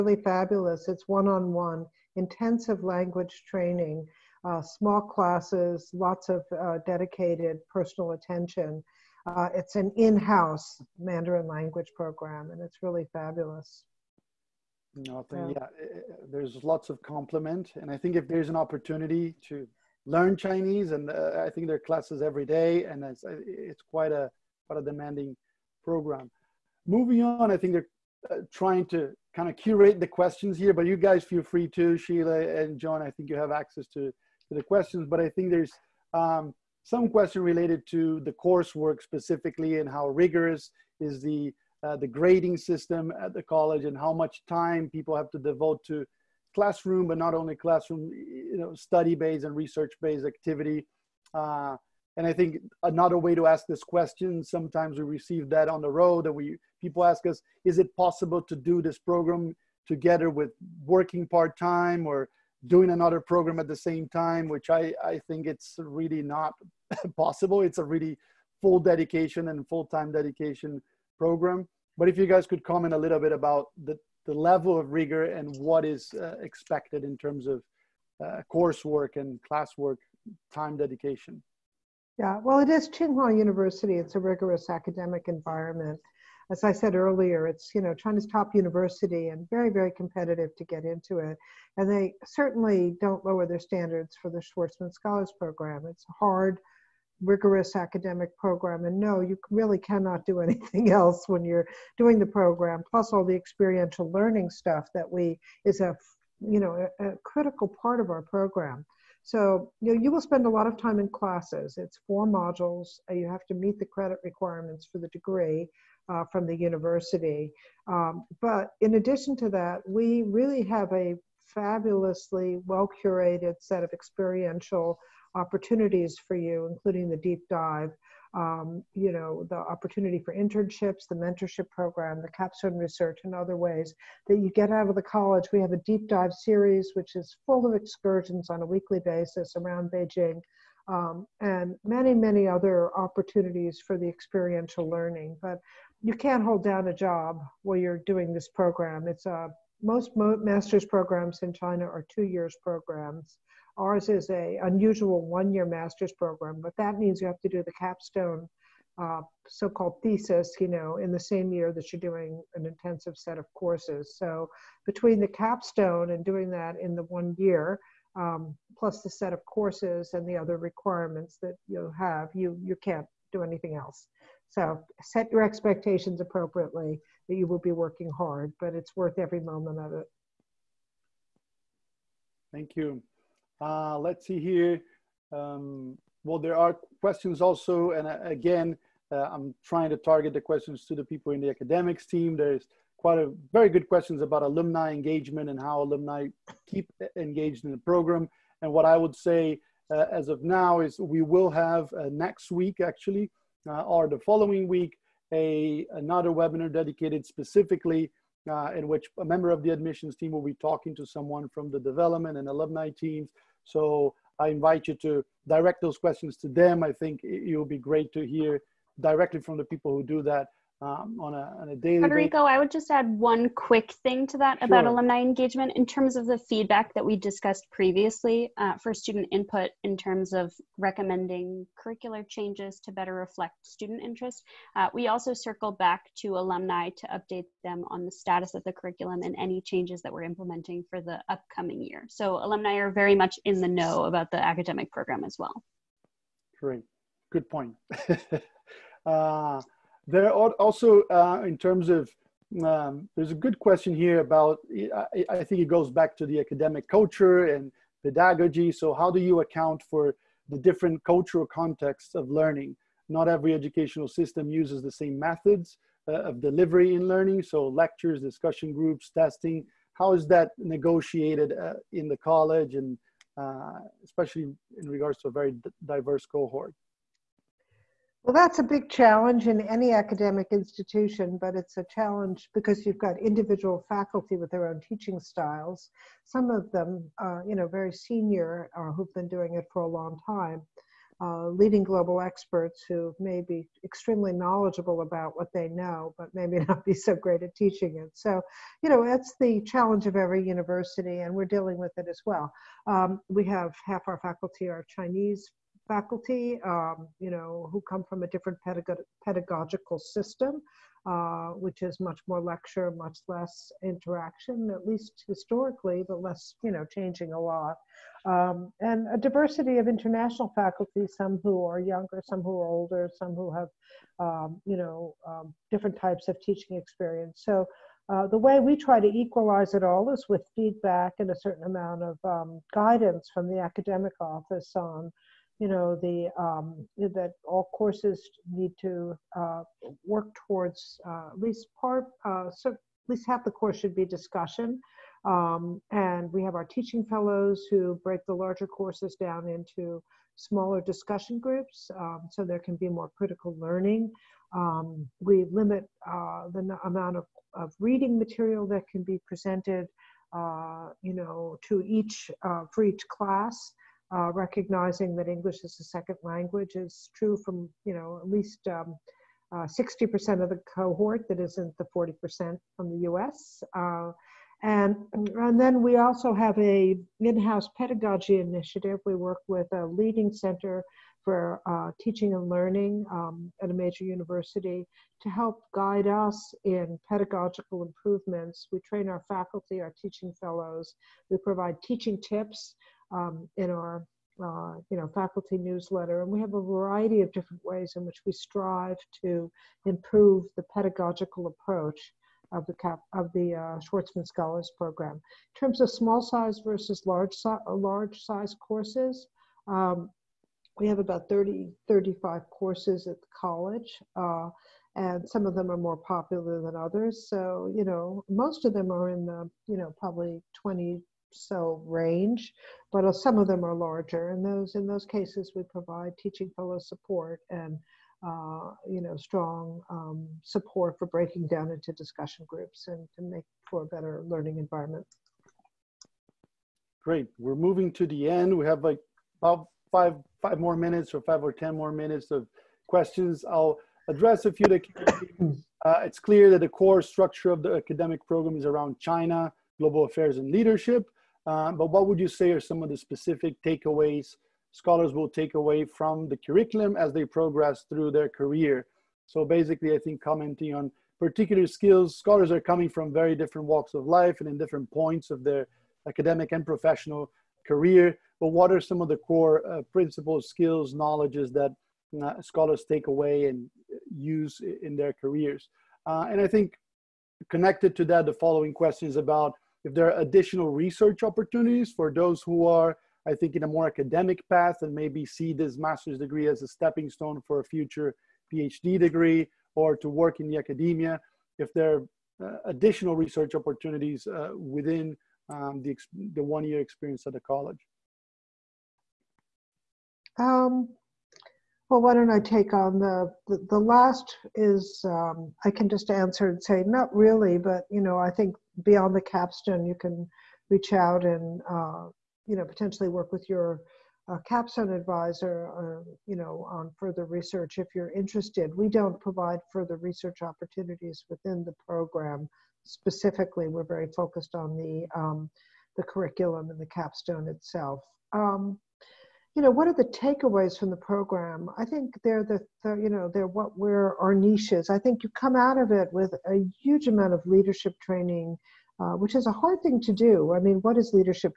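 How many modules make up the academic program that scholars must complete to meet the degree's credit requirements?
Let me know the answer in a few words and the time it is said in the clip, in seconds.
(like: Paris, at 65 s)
4, at 112 s.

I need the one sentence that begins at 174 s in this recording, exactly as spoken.
So set your expectations appropriately that you will be working hard, but it's worth every moment of it.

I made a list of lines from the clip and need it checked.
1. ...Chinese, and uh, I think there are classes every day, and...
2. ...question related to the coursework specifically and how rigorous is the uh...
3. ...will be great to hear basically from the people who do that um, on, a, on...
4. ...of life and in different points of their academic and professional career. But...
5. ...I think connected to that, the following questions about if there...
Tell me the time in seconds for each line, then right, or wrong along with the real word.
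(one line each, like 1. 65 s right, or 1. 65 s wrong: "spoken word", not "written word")
1. 20 s right
2. 37 s right
3. 217 s wrong: "directly", not "basically"
4. 463 s right
5. 476 s right.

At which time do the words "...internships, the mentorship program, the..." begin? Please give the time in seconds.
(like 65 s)
130 s.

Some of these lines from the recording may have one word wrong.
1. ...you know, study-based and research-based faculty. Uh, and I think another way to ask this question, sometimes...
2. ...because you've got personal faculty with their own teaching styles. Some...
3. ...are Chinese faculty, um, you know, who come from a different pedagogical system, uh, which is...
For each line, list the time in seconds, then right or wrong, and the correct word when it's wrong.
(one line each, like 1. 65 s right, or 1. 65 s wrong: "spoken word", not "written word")
1. 48 s wrong: "activity", not "faculty"
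2. 282 s wrong: "individual", not "personal"
3. 304 s right.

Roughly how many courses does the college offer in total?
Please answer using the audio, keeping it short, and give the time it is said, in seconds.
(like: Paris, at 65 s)
30 to 35, at 411 s.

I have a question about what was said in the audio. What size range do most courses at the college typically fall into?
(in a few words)
About 20.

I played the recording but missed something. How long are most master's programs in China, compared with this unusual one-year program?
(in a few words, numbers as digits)
2 years.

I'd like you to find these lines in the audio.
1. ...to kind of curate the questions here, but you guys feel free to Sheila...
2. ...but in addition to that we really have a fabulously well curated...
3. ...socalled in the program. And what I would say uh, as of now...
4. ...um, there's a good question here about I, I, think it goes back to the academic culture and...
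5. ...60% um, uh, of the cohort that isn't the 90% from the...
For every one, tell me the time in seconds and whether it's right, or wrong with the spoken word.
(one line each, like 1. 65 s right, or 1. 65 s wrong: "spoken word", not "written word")
1. 28 s right
2. 118 s right
3. 197 s wrong: "engaged", not "socalled"
4. 252 s right
5. 368 s wrong: "40", not "90".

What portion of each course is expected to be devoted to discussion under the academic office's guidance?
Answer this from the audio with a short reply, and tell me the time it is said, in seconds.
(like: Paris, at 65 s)
At least half, at 342 s.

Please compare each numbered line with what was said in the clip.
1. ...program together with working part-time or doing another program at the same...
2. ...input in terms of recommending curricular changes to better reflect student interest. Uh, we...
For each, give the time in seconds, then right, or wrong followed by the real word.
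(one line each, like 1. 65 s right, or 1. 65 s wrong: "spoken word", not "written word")
1. 58 s right
2. 229 s right.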